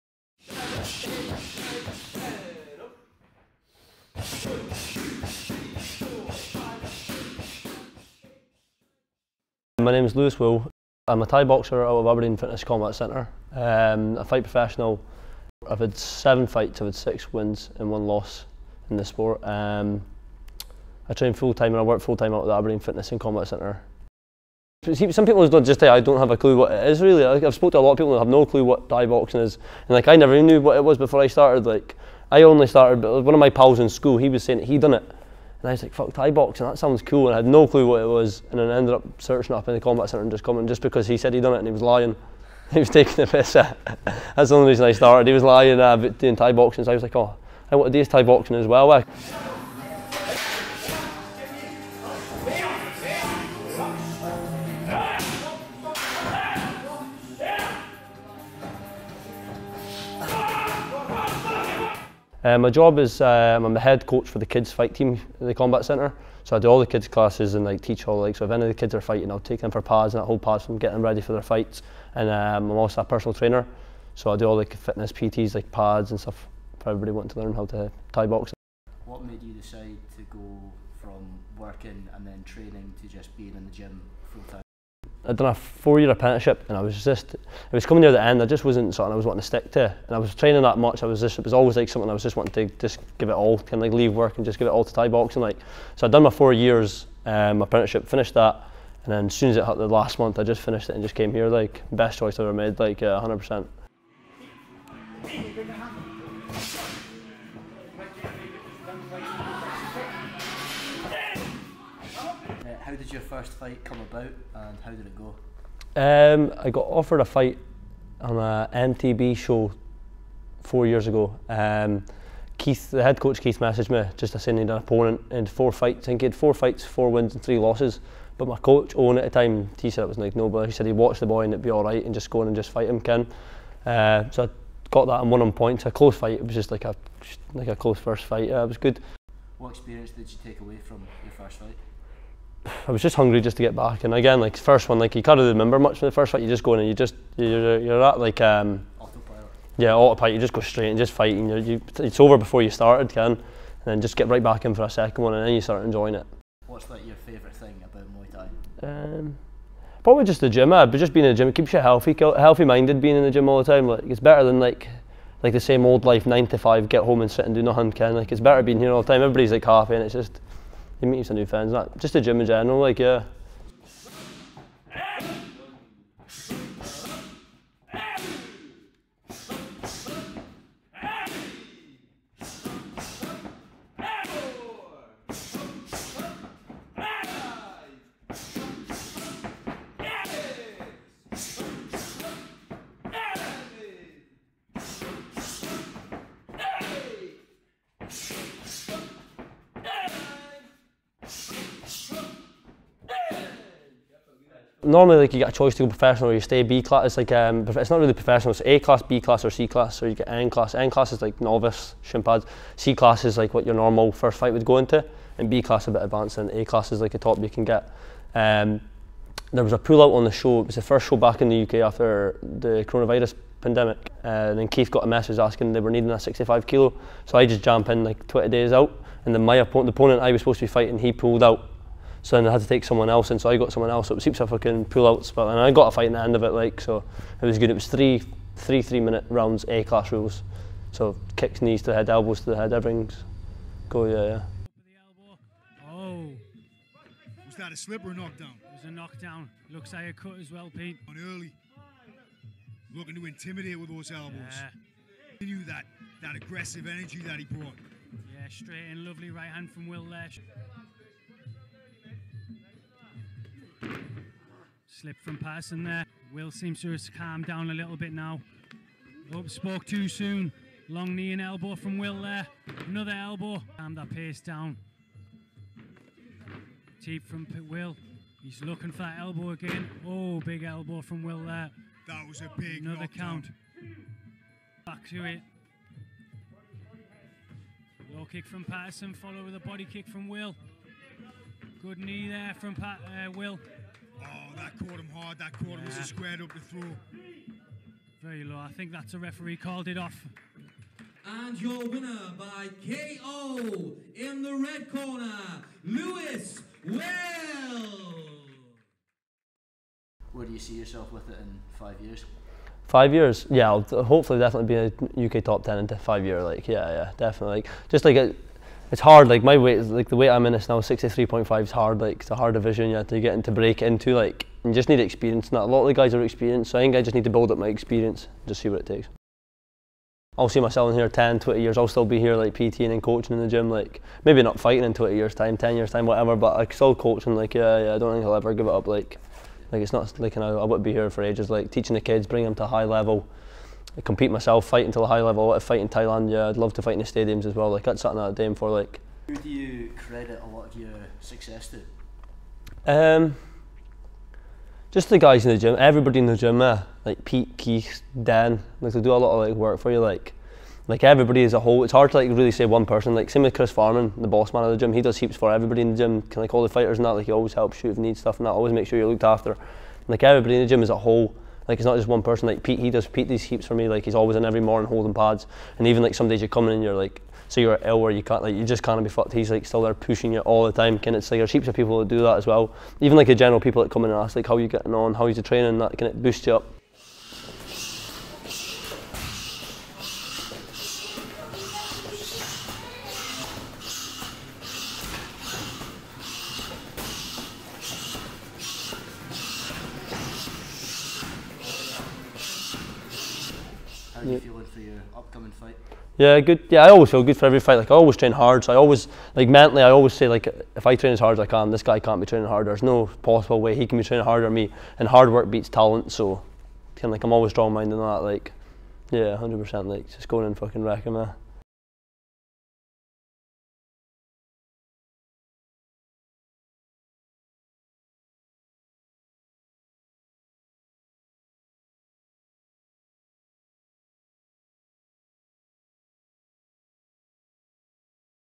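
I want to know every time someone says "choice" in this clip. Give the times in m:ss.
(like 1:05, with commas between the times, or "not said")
1:42, 3:25.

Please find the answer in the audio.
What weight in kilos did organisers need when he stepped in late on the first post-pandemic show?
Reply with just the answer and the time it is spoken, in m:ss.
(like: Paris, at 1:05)
65 kilos, at 3:46.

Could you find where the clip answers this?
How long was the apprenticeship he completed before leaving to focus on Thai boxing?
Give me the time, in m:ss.
1:25.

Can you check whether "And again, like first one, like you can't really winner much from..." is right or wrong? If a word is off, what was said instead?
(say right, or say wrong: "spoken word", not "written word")
wrong: "remember", not "winner".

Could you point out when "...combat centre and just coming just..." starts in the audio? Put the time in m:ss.
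0:39.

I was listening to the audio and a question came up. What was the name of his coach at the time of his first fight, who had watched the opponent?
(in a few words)
Owen.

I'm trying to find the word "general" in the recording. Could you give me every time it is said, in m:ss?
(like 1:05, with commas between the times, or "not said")
2:52, 6:23.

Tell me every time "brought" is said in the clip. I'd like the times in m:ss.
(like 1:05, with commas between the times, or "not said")
4:17.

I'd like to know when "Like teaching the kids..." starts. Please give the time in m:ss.
5:41.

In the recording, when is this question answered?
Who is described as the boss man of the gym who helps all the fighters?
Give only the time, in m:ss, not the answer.
6:03.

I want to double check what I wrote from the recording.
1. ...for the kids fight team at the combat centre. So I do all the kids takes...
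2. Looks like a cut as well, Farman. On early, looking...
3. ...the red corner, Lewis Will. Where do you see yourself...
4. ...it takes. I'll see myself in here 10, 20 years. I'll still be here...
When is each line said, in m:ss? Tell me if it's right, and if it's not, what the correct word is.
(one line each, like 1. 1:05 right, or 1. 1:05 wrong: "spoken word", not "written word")
1. 1:04 wrong: "classes", not "takes"
2. 4:09 wrong: "Pete", not "Farman"
3. 5:04 right
4. 5:28 right.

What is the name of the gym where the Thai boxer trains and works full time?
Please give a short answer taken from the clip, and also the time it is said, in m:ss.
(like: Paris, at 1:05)
Aberdeen Fitness Combat Centre, at 0:12.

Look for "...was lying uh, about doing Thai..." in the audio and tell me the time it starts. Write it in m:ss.
0:45.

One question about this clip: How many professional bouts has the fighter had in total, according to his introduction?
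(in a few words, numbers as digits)
7.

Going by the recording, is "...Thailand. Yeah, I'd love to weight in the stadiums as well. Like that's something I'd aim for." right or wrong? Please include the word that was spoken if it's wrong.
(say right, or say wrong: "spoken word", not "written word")
wrong: "fight", not "weight".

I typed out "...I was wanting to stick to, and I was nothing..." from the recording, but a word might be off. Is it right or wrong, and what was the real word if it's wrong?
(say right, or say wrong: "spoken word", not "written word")
wrong: "training", not "nothing".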